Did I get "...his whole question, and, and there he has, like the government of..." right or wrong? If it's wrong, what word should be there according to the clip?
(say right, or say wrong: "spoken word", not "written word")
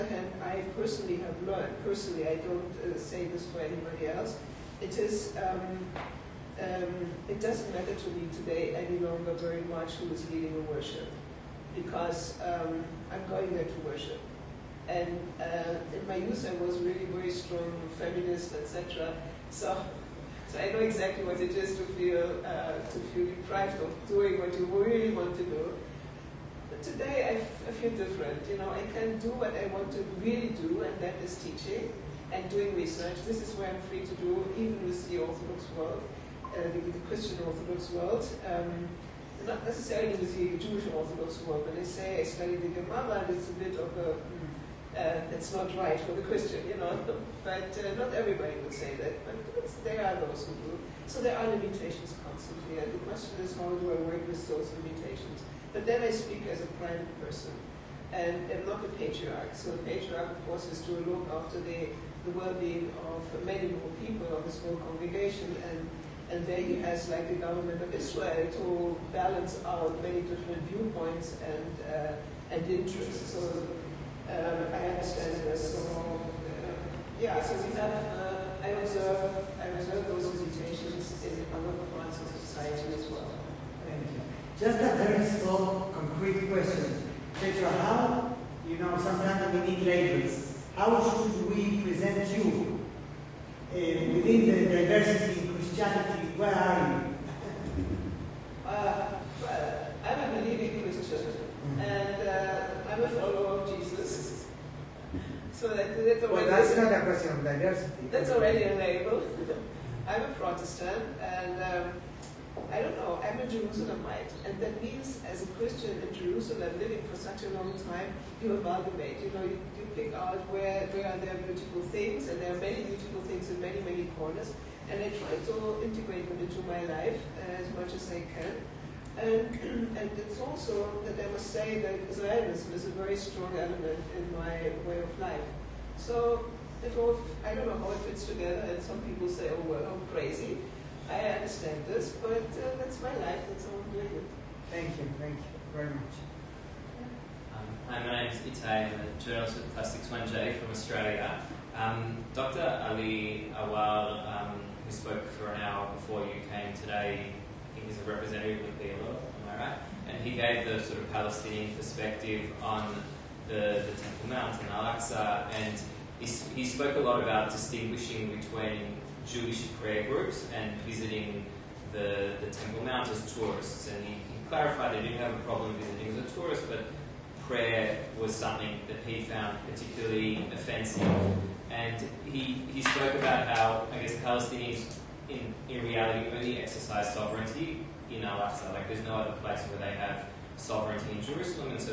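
wrong: "congregation", not "question".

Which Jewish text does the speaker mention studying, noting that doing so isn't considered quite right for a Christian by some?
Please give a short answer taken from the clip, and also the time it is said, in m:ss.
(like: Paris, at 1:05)
Gemara, at 0:42.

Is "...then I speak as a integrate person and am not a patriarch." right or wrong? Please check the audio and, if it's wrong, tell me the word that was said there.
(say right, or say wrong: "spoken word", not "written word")
wrong: "private", not "integrate".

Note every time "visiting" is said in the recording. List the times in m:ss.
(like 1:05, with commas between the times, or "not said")
2:50, 2:55.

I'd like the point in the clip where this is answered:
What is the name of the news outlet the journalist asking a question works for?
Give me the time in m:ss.
2:29.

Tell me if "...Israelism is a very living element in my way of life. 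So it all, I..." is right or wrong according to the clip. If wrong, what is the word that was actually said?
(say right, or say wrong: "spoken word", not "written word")
wrong: "strong", not "living".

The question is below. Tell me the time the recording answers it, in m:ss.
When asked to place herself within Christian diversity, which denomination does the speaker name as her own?
1:50.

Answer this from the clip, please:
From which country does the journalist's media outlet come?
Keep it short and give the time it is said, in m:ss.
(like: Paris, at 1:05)
Australia, at 2:30.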